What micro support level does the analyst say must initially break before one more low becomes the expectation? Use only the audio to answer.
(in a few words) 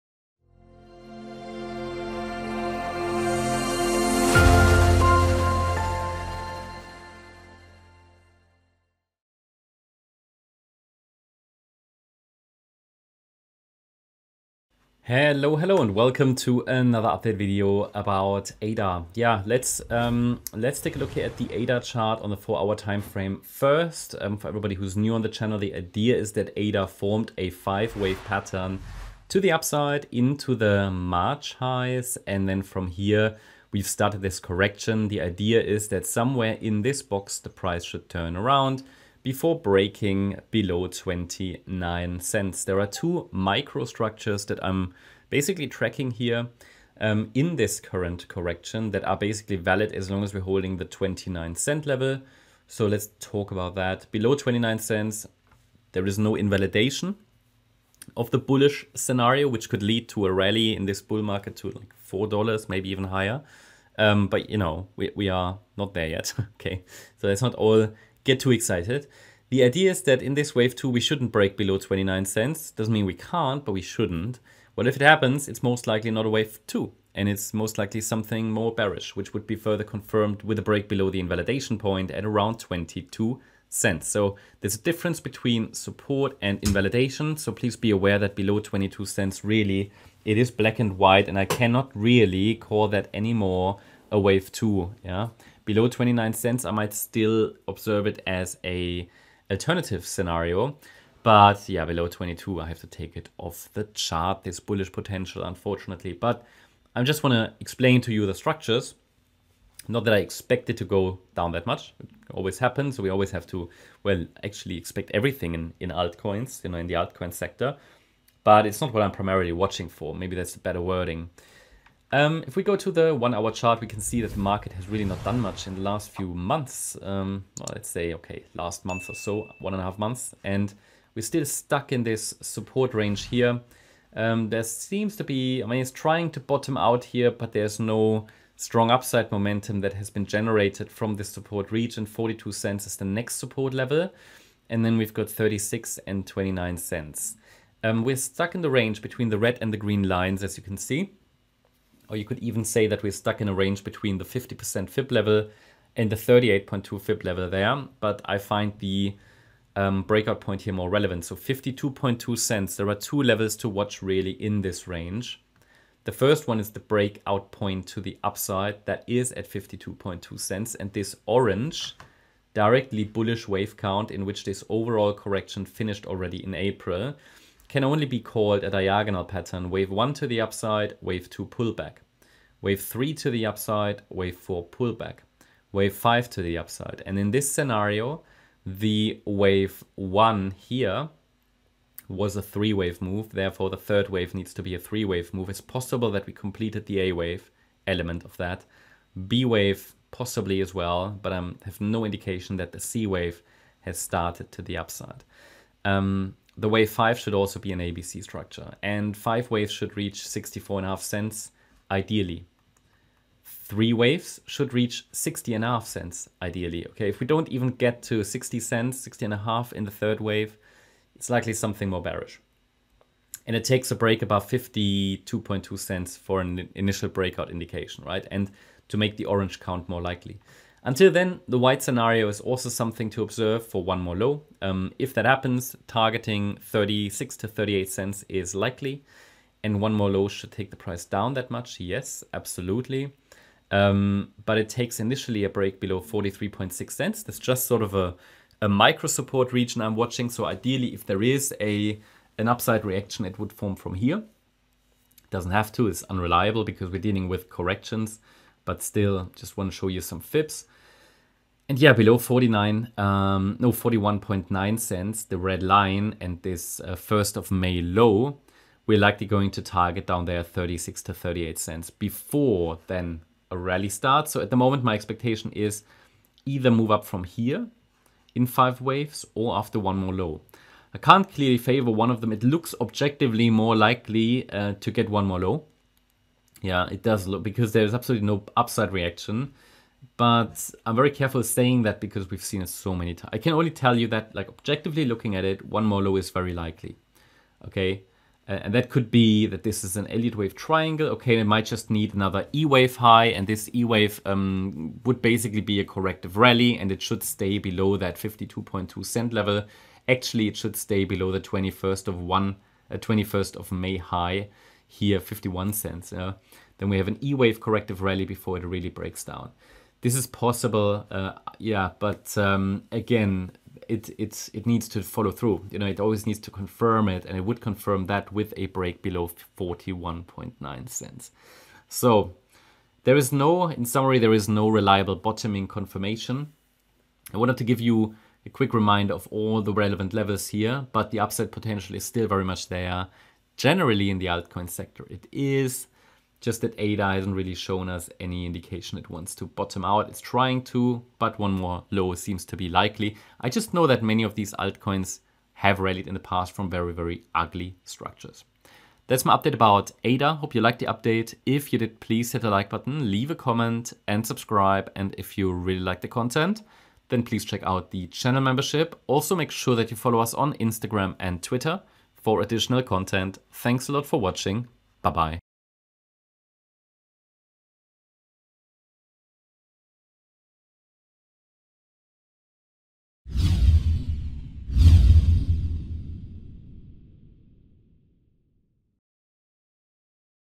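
43.6 cents.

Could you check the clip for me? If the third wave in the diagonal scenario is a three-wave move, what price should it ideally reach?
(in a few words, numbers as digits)
60.5 cents.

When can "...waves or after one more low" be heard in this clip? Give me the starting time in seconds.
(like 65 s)
278 s.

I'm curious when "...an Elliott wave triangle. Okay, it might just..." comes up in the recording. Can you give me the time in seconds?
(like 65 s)
299 s.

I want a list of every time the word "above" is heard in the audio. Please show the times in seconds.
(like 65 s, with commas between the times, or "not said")
224 s.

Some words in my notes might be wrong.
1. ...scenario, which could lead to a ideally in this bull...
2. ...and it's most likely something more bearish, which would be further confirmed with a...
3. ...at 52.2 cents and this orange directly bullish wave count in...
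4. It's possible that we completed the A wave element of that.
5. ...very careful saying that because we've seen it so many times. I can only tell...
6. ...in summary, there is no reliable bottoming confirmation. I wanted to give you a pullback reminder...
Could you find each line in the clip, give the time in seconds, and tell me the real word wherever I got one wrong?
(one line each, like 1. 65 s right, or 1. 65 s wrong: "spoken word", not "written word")
1. 58 s wrong: "rally", not "ideally"
2. 77 s right
3. 169 s right
4. 195 s right
5. 290 s right
6. 333 s wrong: "quick", not "pullback".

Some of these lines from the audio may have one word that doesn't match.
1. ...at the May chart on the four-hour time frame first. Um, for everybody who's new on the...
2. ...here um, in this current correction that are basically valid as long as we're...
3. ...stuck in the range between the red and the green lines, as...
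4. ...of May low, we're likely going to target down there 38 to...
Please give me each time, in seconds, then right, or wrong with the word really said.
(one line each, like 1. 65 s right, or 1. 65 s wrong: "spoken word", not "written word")
1. 21 s wrong: "ADA", not "May"
2. 46 s right
3. 148 s right
4. 267 s wrong: "36", not "38".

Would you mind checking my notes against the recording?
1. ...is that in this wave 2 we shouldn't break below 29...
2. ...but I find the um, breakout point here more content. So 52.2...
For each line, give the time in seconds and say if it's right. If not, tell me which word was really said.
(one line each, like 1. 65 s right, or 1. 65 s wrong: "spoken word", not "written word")
1. 69 s right
2. 158 s wrong: "relevant", not "content".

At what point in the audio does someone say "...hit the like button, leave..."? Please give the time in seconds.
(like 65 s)
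362 s.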